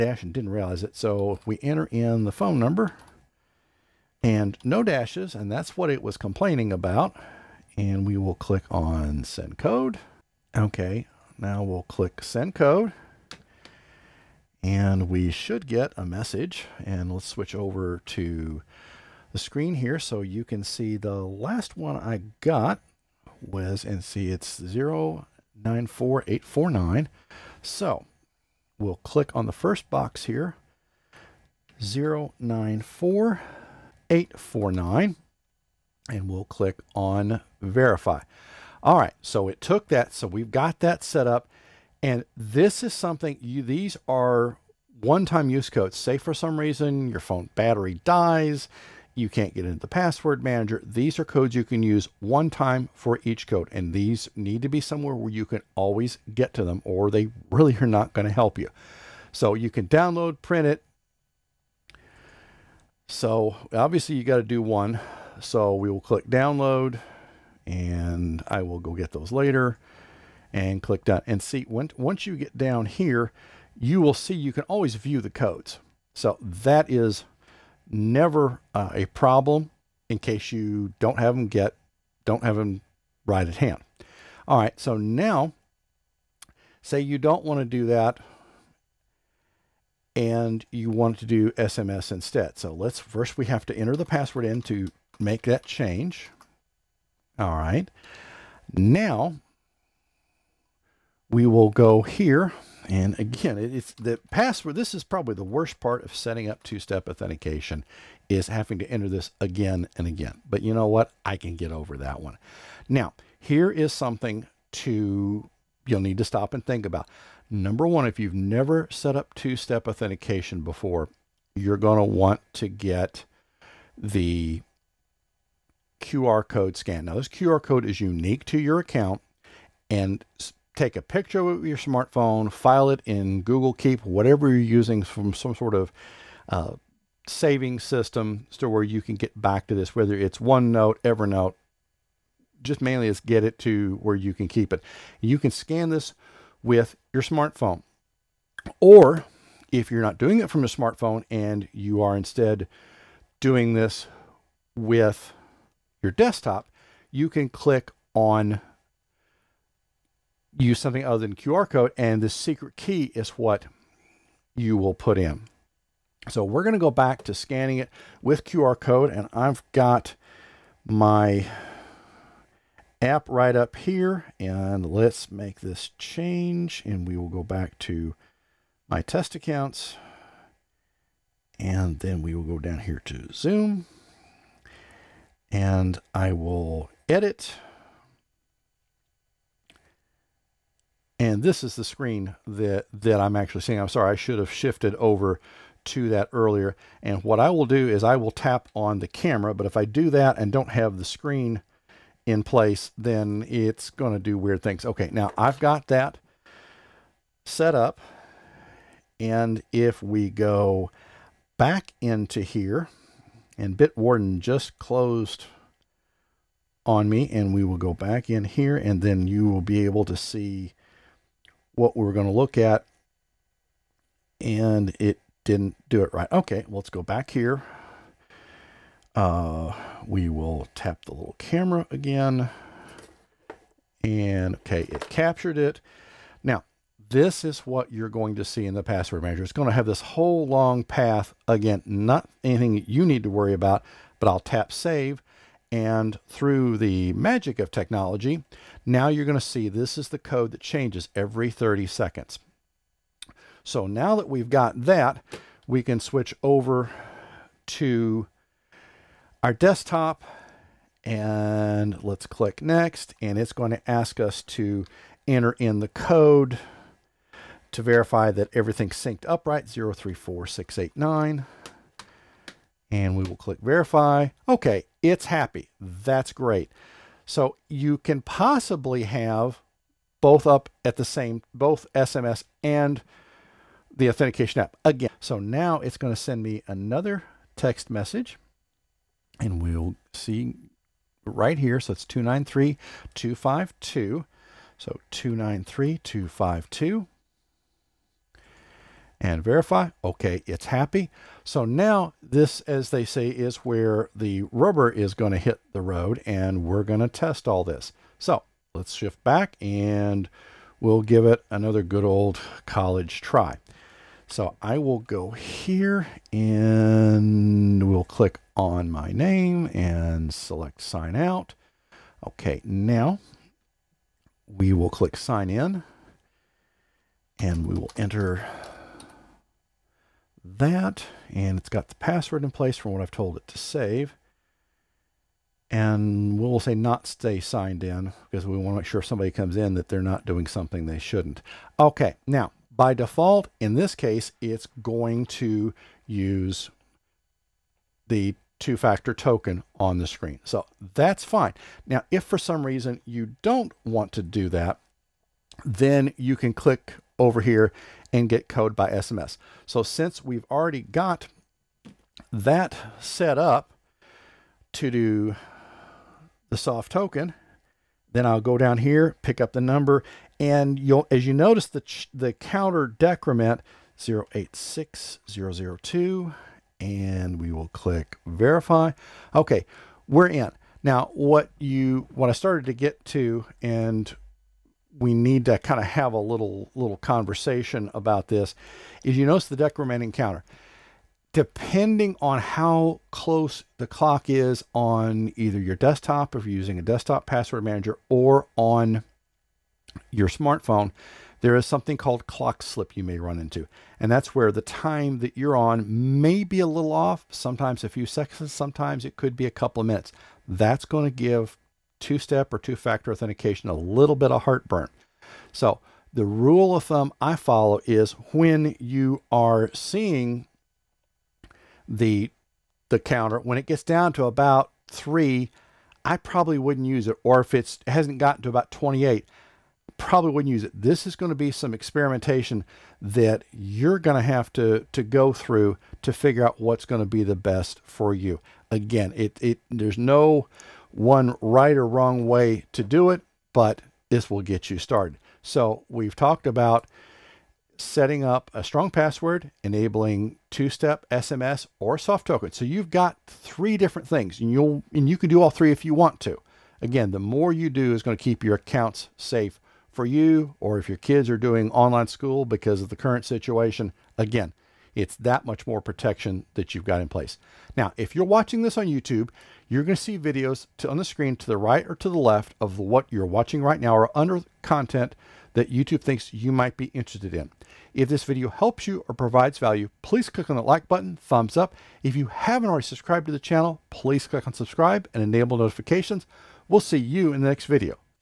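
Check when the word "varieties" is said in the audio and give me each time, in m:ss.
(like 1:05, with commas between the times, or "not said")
not said.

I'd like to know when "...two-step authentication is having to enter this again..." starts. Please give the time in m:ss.
1:46.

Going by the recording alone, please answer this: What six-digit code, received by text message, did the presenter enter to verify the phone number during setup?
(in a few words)
094849.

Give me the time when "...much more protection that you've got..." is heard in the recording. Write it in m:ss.
7:45.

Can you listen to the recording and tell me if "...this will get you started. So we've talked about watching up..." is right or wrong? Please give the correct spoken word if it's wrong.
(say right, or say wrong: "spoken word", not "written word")
wrong: "setting", not "watching".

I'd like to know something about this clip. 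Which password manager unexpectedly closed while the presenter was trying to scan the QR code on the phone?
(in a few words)
Bitwarden.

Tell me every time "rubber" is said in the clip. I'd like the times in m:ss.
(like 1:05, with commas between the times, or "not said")
5:04.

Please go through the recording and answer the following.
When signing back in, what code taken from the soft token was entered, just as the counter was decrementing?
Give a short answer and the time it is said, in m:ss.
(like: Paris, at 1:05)
086002, at 6:13.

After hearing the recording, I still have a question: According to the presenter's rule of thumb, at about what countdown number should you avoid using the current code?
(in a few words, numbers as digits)
3.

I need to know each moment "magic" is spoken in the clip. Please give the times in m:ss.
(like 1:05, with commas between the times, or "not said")
4:07.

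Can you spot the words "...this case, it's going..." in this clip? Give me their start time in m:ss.
5:43.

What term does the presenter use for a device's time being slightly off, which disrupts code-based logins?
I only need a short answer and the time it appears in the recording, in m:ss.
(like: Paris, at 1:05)
clock slip, at 6:42.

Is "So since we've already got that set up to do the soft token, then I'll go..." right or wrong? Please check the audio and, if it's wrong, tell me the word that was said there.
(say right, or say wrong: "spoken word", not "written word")
right.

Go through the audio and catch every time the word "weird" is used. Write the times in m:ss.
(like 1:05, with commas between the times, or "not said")
3:24.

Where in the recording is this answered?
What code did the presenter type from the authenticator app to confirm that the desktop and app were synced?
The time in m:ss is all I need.
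4:29.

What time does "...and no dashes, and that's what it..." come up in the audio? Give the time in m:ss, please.
0:04.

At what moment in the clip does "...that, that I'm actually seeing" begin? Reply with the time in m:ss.
3:12.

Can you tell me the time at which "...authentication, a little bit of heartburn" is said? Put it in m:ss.
6:53.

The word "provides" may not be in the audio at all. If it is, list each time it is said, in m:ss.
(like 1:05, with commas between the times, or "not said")
7:59.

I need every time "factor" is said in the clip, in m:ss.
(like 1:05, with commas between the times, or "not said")
5:48, 6:52.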